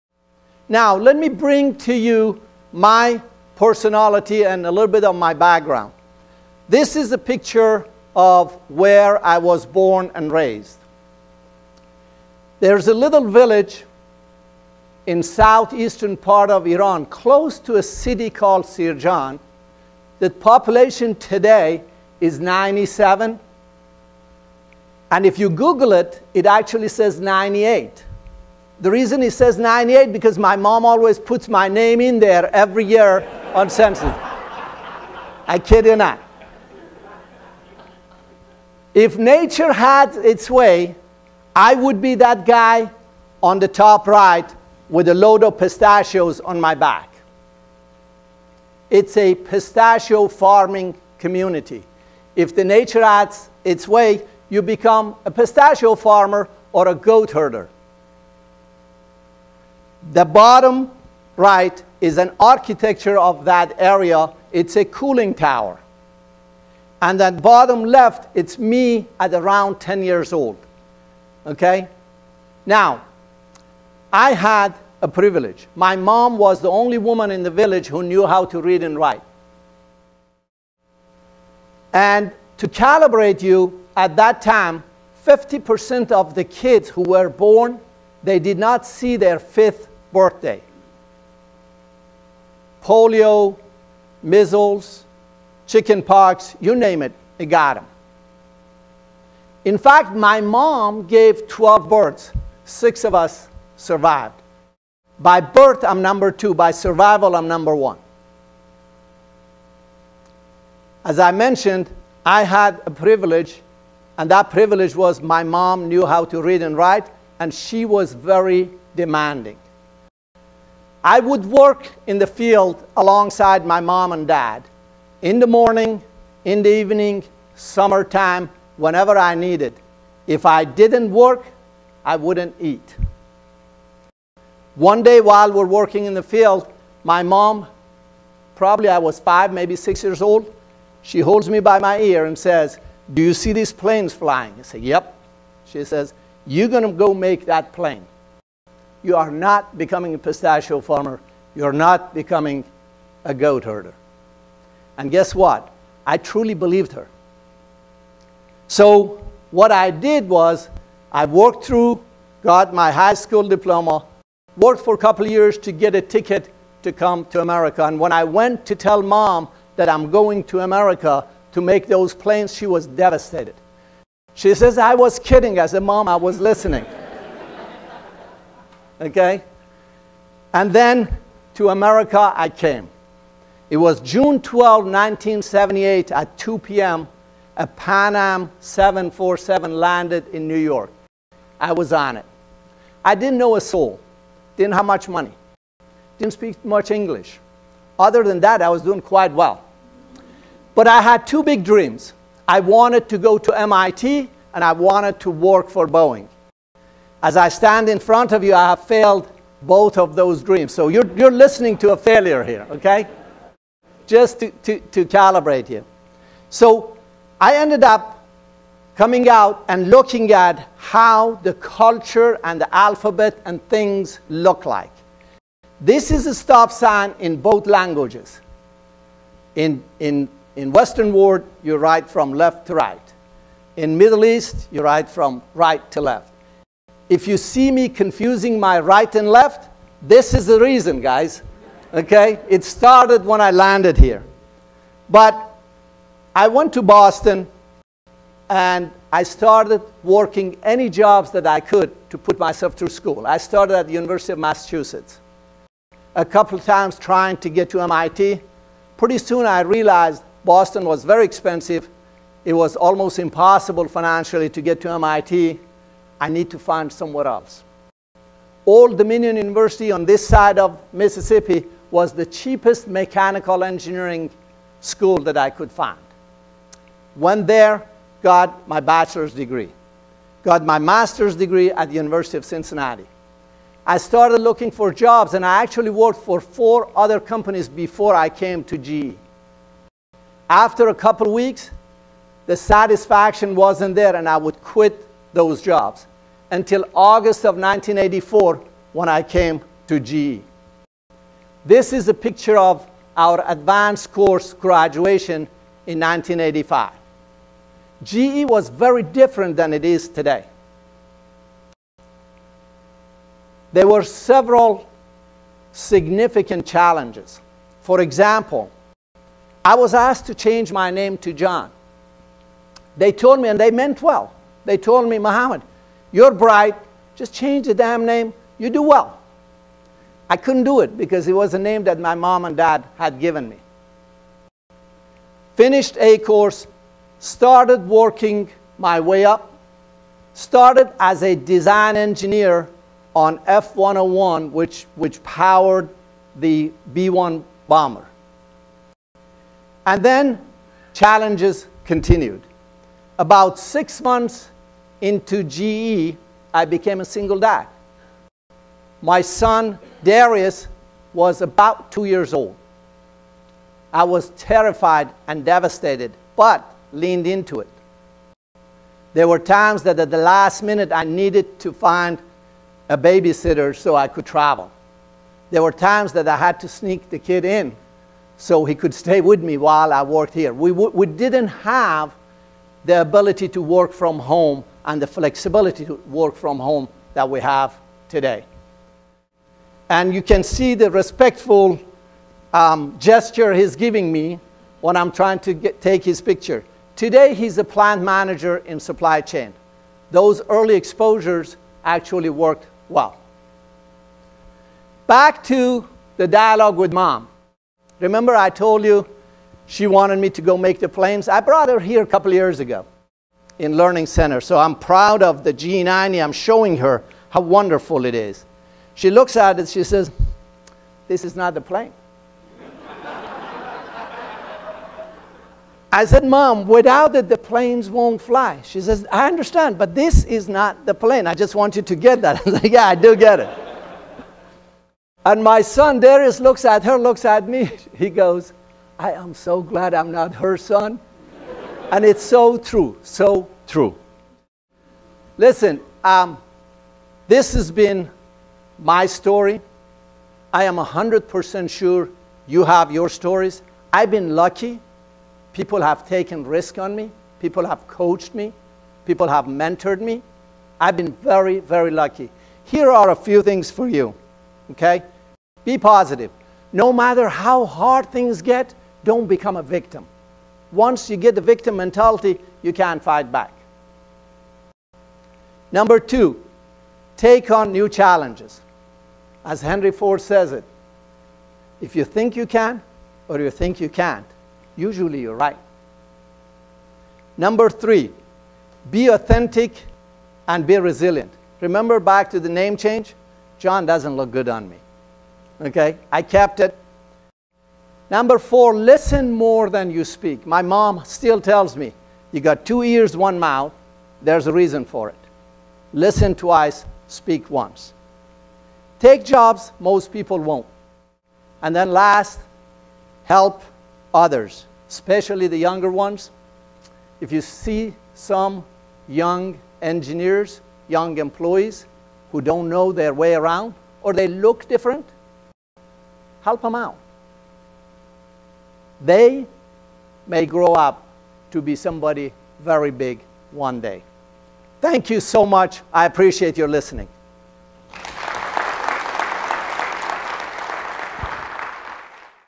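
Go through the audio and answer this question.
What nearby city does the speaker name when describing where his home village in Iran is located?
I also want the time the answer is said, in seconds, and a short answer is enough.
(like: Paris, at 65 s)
Sirjan, at 18 s.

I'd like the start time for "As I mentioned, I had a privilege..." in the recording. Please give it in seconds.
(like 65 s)
111 s.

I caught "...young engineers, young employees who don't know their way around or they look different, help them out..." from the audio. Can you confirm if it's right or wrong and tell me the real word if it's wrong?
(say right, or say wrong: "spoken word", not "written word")
right.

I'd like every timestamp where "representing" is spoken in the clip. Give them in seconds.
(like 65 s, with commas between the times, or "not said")
not said.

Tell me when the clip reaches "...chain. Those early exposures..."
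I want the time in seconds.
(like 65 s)
399 s.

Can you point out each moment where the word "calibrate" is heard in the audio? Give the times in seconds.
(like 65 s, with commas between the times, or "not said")
82 s, 215 s.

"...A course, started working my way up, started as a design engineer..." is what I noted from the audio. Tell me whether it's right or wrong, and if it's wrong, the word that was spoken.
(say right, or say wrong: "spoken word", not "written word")
right.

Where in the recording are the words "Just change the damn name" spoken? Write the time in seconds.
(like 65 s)
327 s.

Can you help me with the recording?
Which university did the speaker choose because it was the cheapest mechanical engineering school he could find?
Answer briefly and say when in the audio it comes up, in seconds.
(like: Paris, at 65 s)
Old Dominion University, at 268 s.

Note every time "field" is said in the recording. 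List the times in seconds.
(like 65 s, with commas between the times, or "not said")
122 s, 136 s.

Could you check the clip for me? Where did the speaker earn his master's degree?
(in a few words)
University of Cincinnati.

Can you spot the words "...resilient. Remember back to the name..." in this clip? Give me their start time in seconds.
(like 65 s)
490 s.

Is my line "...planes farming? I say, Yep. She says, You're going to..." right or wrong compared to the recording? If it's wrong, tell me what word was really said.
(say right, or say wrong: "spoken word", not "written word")
wrong: "flying", not "farming".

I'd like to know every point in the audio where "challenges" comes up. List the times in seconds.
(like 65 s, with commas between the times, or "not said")
316 s, 350 s, 477 s.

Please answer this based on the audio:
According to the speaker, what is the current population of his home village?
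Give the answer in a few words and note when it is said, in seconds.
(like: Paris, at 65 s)
97, at 22 s.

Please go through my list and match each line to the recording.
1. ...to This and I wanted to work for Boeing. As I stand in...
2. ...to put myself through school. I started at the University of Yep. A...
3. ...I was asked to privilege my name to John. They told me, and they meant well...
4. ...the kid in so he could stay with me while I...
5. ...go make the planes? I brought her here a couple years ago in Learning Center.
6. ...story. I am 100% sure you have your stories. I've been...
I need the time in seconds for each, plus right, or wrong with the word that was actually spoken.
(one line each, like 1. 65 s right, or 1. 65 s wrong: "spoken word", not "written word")
1. 203 s wrong: "MIT", not "This"
2. 252 s wrong: "Massachusetts", not "Yep"
3. 319 s wrong: "change", not "privilege"
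4. 377 s right
5. 410 s right
6. 449 s right.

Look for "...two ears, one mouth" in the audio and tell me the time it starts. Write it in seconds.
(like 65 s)
502 s.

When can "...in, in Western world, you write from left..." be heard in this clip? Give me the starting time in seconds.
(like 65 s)
229 s.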